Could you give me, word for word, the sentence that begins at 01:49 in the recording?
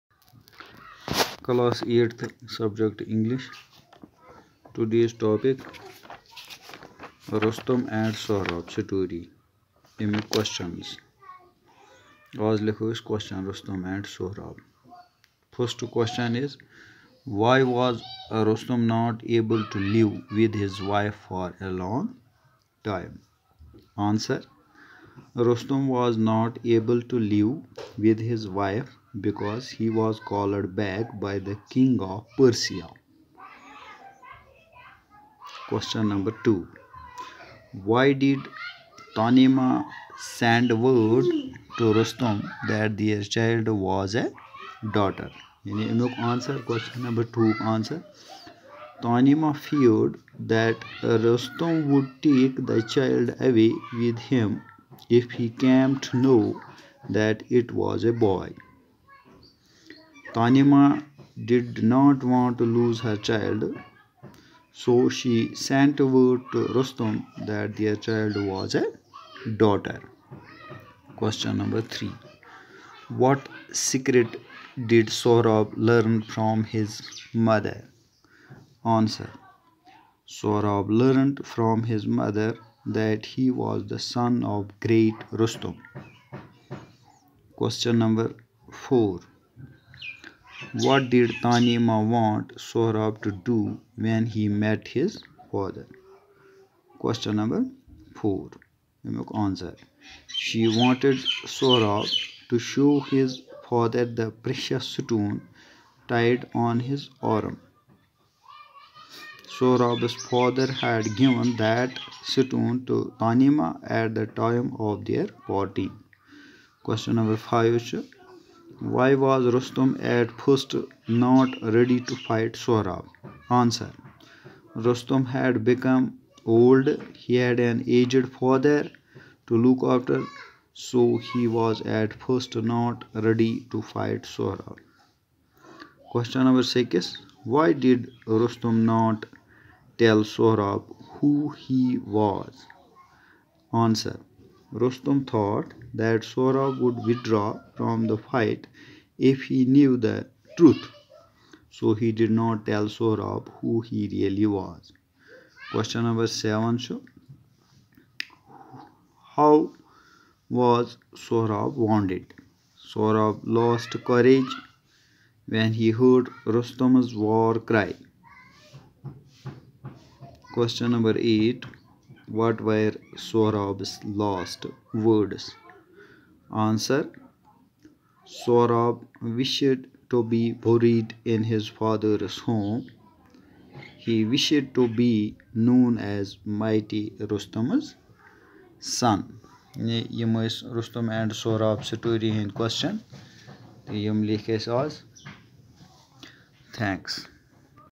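Sohrab's father had given that stone to Tanima at the time of their party.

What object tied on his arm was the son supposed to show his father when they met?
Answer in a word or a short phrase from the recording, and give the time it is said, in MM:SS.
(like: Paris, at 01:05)
Precious stone, at 01:44.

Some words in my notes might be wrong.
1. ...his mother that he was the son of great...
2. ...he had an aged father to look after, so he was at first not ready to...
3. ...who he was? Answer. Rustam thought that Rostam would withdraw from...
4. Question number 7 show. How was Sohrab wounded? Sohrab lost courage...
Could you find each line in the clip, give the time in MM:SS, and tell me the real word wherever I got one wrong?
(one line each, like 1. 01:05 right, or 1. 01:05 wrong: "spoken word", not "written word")
1. 01:21 right
2. 02:07 right
3. 02:21 wrong: "Sora", not "Rostam"
4. 02:35 right.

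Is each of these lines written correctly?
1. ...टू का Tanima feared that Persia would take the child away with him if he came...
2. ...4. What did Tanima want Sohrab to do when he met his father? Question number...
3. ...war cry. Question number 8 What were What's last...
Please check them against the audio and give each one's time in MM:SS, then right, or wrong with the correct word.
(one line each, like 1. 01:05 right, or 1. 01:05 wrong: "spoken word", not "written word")
1. 00:47 wrong: "Rustam", not "Persia"
2. 01:28 right
3. 02:47 wrong: "Sorov", not "What".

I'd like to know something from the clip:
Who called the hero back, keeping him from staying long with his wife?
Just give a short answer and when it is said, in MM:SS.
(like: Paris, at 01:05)
King of Persia, at 00:31.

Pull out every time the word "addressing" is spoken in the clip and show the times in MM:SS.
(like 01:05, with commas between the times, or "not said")
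not said.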